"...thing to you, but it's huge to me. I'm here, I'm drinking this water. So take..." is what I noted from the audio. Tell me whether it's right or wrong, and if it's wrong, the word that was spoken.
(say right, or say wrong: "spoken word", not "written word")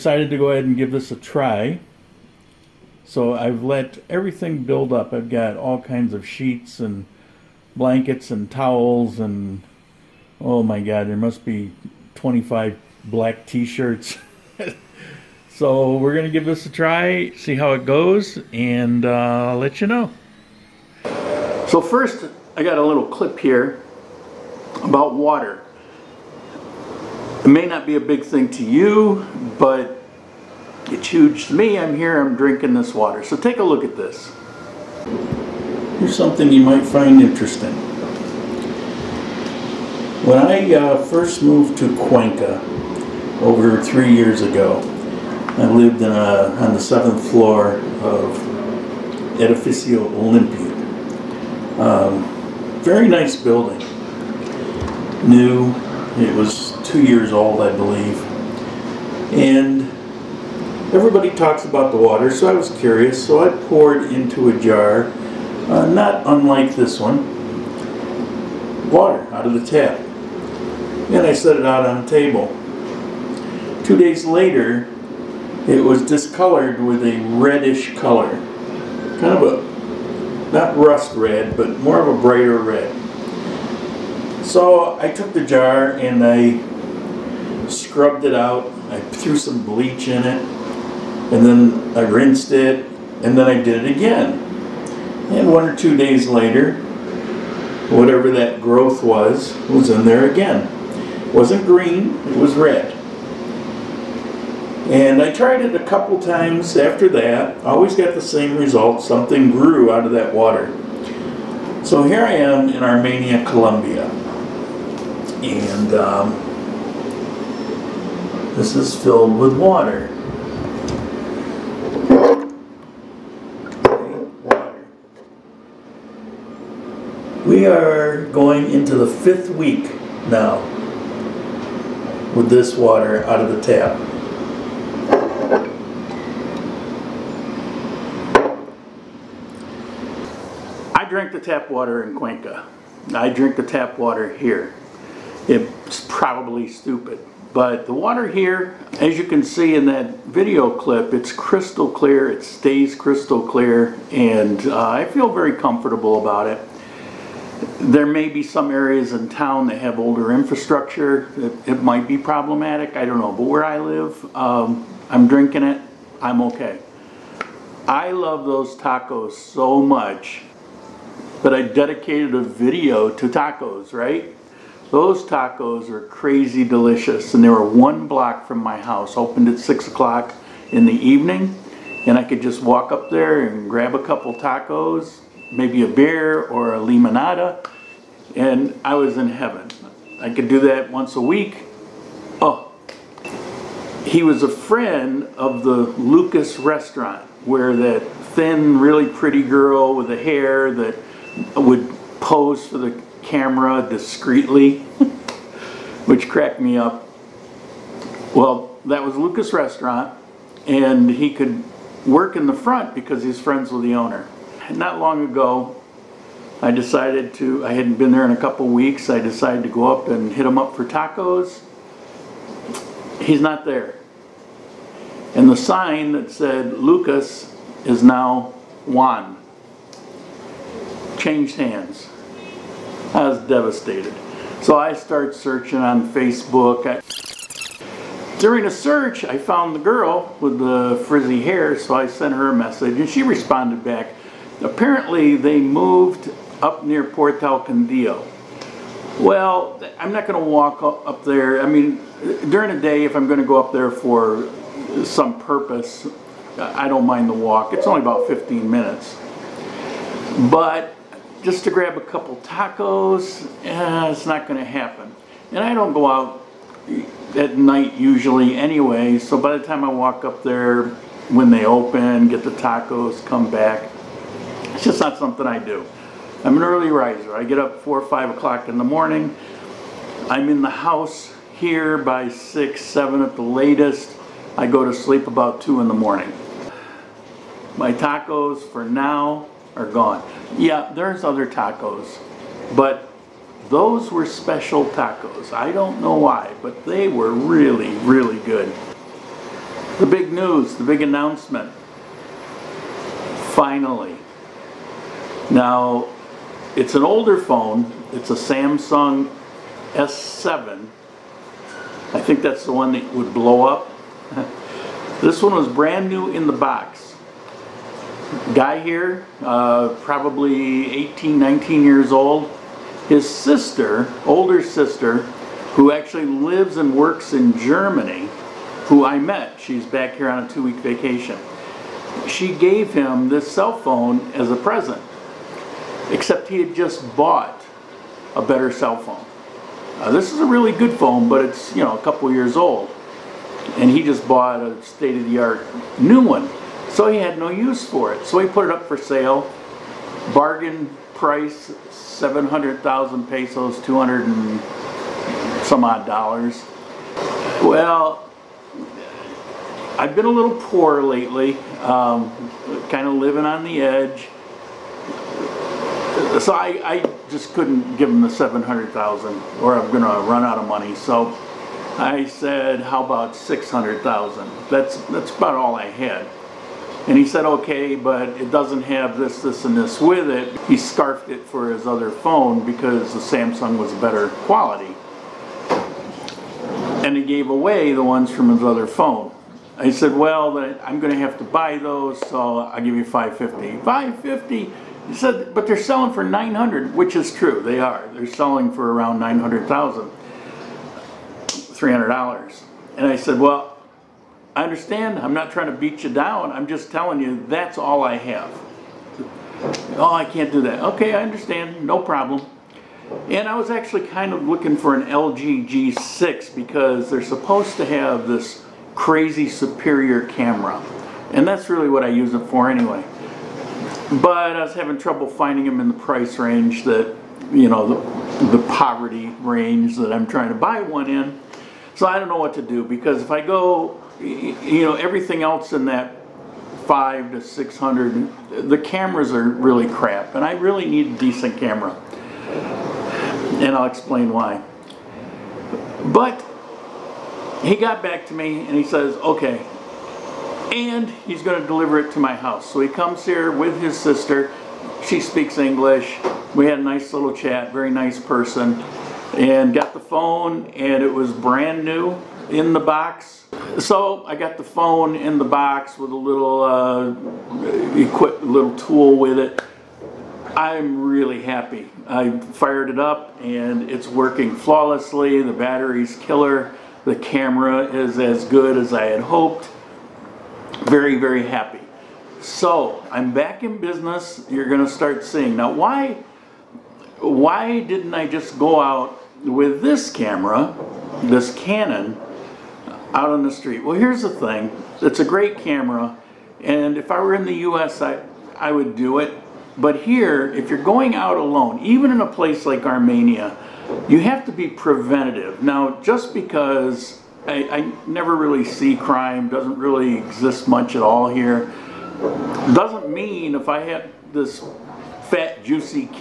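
right.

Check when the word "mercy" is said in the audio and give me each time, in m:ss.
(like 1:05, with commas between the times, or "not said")
not said.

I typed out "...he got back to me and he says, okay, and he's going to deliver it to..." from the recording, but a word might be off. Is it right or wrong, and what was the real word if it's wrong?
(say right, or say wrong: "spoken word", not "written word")
right.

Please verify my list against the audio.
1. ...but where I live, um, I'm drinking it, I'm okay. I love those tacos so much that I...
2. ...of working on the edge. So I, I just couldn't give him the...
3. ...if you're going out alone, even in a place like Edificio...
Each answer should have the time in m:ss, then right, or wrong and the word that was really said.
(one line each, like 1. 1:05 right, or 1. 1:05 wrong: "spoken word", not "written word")
1. 2:43 right
2. 6:03 wrong: "living", not "working"
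3. 8:20 wrong: "Armenia", not "Edificio".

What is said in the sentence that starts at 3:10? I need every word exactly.
I could do that once a week.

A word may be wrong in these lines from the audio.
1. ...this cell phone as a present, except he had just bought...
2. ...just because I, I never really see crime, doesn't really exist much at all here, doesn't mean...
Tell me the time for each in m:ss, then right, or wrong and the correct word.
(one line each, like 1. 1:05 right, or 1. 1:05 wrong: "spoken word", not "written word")
1. 5:33 right
2. 8:26 right.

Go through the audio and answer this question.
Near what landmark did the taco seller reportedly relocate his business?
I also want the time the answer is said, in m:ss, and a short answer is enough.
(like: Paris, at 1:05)
Portal Quindío, at 4:07.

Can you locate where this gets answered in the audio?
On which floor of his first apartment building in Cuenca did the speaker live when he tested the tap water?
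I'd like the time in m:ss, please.
0:46.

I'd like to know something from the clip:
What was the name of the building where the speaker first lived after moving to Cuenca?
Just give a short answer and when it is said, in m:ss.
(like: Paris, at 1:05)
Edificio Olympia, at 0:49.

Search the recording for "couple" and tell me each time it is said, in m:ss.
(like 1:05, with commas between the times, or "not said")
1:45, 3:04, 3:38, 4:21, 5:42.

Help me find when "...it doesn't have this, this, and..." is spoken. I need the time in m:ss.
6:18.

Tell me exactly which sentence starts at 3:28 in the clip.
Well, that was Lucas Restaurant, and he could work in the front because he's friends with the owner.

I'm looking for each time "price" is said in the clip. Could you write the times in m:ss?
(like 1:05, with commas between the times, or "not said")
5:51, 7:05.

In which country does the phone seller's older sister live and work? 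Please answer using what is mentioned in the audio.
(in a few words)
Germany.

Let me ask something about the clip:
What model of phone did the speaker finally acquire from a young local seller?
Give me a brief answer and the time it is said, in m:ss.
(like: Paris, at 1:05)
Samsung S7, at 5:08.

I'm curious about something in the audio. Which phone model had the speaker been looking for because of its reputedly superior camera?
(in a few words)
LG G6.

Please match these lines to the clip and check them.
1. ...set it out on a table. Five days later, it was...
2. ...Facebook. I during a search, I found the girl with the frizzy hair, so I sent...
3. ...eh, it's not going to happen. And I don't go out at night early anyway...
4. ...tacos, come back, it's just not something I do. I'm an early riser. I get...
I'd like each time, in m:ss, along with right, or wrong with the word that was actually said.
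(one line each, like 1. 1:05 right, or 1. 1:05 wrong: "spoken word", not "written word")
1. 1:11 wrong: "Two", not "Five"
2. 3:56 right
3. 4:23 wrong: "usually", not "early"
4. 4:32 right.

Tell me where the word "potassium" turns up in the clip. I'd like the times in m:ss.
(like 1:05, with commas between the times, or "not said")
not said.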